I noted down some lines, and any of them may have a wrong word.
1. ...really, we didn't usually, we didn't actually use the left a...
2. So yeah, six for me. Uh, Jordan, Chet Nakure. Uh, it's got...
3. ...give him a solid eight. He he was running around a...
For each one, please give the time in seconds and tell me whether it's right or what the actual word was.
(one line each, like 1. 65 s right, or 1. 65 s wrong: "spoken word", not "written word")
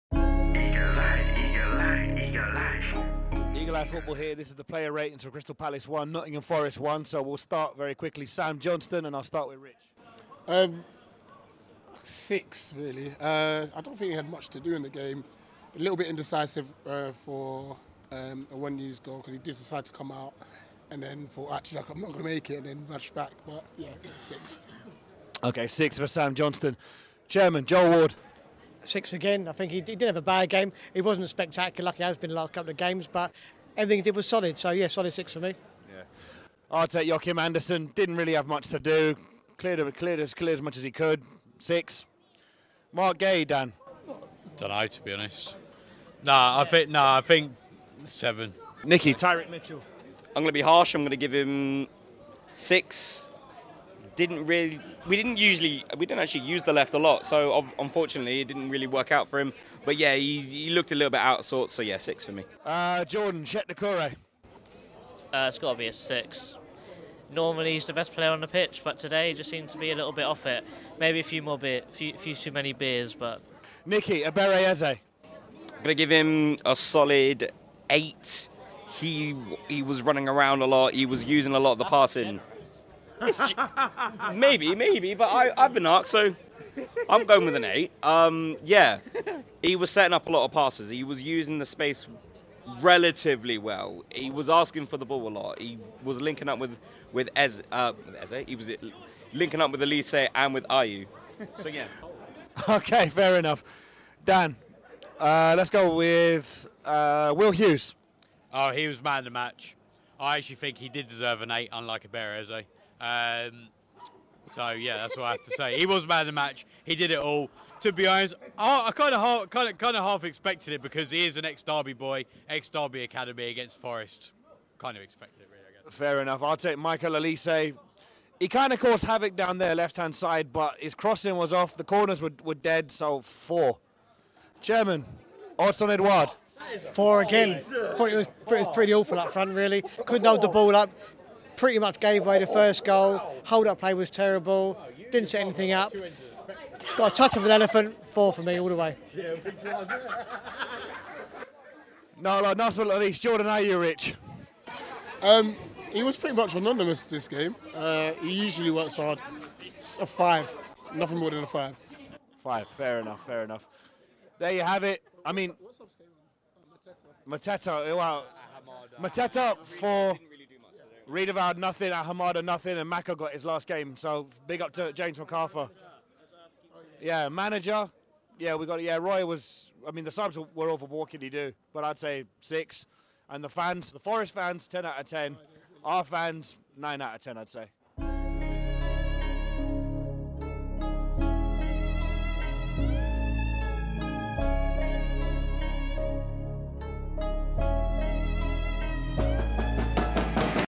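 1. 54 s right
2. 61 s right
3. 75 s right.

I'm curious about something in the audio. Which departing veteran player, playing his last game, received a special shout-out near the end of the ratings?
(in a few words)
James McArthur.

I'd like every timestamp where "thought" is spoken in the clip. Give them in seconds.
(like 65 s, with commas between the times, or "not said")
21 s, 137 s.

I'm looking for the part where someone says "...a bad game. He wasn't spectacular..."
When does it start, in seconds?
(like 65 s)
30 s.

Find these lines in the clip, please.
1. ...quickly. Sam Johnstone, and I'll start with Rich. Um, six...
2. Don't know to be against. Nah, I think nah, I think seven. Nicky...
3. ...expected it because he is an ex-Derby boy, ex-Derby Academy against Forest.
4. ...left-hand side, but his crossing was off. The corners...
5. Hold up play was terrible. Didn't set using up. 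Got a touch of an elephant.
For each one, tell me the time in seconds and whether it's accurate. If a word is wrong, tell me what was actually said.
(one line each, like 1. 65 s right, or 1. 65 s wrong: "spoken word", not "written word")
1. 7 s right
2. 44 s wrong: "honest", not "against"
3. 120 s right
4. 129 s right
5. 143 s wrong: "anything", not "using".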